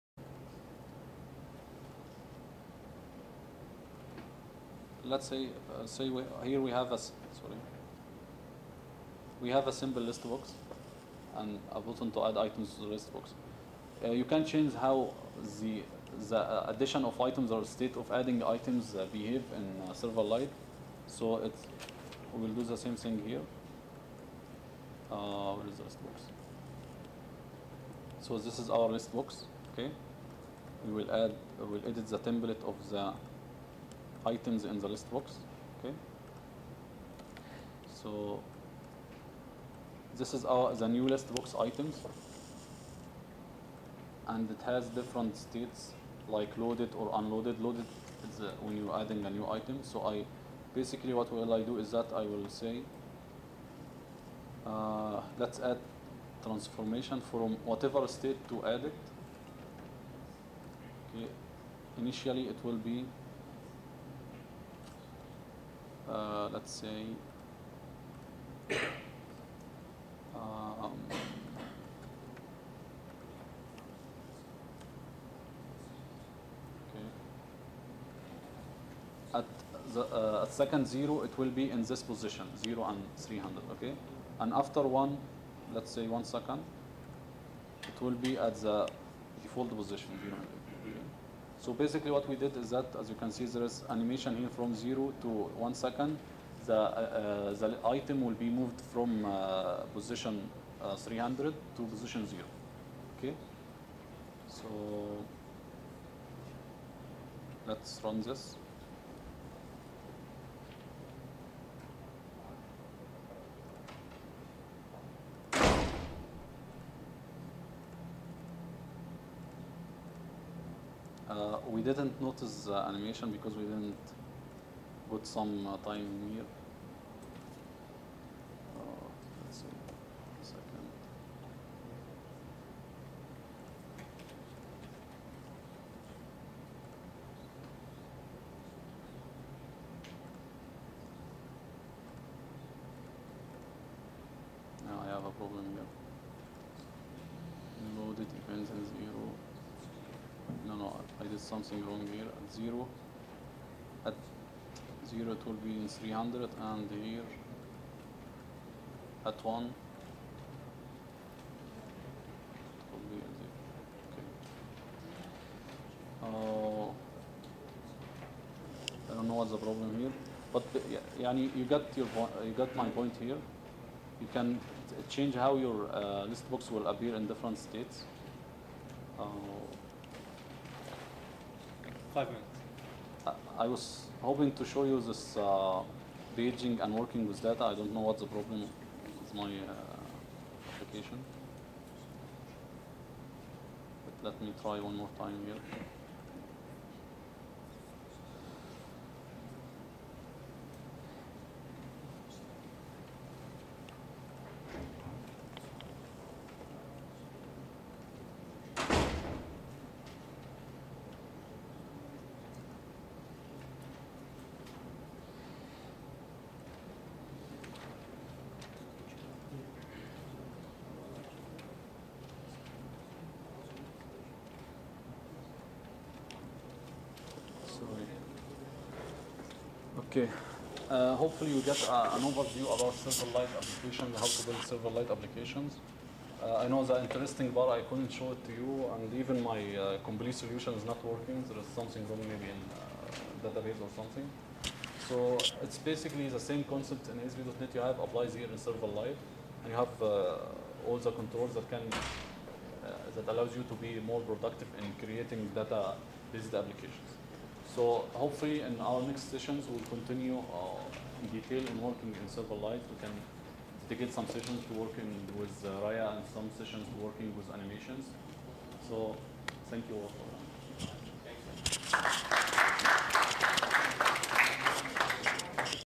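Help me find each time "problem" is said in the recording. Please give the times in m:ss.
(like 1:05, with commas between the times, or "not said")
2:25, 2:49, 3:08.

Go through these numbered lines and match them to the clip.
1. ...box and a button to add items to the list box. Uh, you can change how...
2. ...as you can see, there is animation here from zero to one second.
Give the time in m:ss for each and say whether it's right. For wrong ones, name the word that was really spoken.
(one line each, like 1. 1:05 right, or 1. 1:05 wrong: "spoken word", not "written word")
1. 0:10 right
2. 1:32 right.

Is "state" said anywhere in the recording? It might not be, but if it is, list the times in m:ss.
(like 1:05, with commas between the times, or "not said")
0:17, 0:45, 0:58, 2:57.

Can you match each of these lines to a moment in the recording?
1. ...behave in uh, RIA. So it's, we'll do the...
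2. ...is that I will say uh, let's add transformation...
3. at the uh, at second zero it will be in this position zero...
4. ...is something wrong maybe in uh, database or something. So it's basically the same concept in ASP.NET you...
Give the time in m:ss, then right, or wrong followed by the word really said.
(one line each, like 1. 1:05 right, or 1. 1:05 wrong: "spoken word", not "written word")
1. 0:19 wrong: "Silverlight", not "RIA"
2. 0:51 right
3. 1:19 right
4. 4:01 right.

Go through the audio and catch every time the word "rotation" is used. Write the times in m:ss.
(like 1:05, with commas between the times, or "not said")
not said.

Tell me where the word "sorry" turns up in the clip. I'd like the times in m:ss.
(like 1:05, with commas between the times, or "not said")
0:06.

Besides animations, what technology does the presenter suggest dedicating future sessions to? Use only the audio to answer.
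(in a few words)
RIA.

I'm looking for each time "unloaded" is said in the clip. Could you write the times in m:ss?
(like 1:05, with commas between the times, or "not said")
0:47.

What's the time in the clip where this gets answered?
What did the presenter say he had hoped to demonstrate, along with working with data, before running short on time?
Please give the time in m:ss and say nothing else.
3:06.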